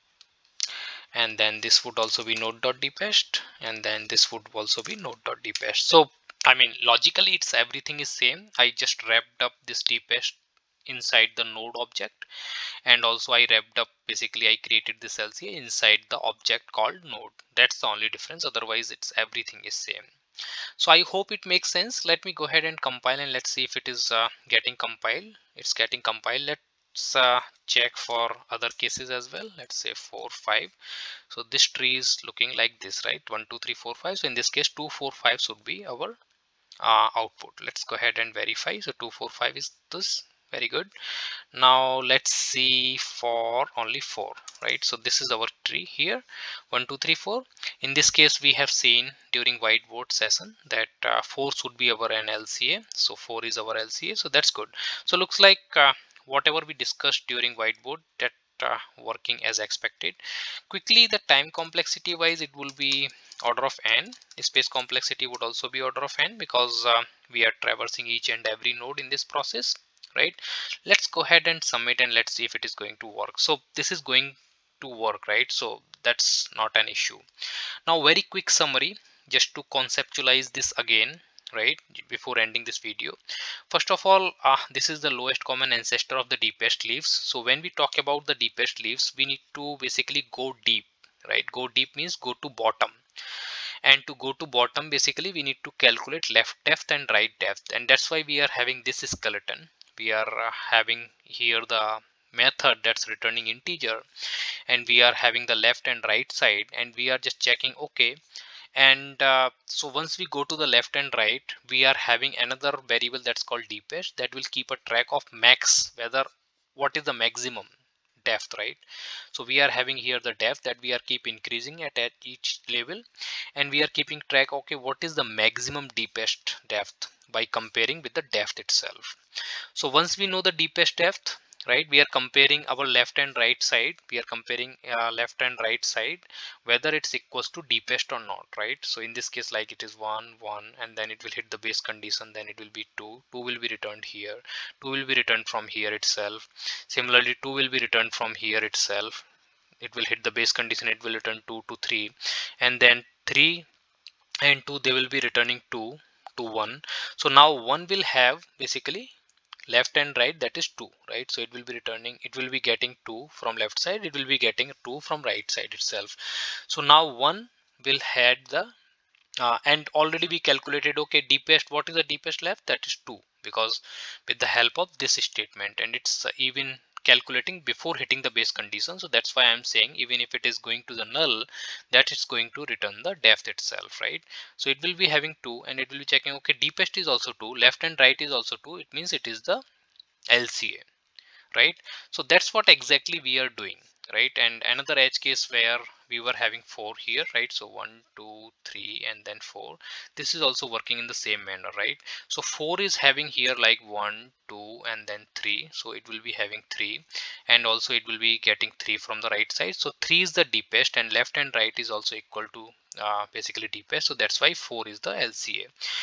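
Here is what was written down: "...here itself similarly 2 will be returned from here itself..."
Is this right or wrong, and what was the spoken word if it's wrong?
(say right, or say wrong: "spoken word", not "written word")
right.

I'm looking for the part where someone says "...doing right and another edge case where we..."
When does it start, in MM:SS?
03:13.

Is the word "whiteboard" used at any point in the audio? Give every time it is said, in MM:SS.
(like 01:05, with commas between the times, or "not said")
00:49, 00:57.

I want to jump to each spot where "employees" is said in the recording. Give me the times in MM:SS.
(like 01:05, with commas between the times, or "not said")
not said.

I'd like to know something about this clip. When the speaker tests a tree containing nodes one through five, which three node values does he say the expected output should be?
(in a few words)
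2 4 5.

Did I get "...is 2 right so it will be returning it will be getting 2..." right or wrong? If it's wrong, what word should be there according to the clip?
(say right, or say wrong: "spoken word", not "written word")
right.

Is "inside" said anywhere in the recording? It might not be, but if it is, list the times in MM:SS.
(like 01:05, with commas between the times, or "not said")
00:10, 00:15.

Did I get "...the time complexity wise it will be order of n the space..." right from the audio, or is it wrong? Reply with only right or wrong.
right.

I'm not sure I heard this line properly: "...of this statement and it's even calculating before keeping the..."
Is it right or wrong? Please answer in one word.
wrong.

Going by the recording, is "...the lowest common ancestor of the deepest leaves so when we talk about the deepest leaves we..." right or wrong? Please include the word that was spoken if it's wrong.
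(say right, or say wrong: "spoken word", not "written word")
right.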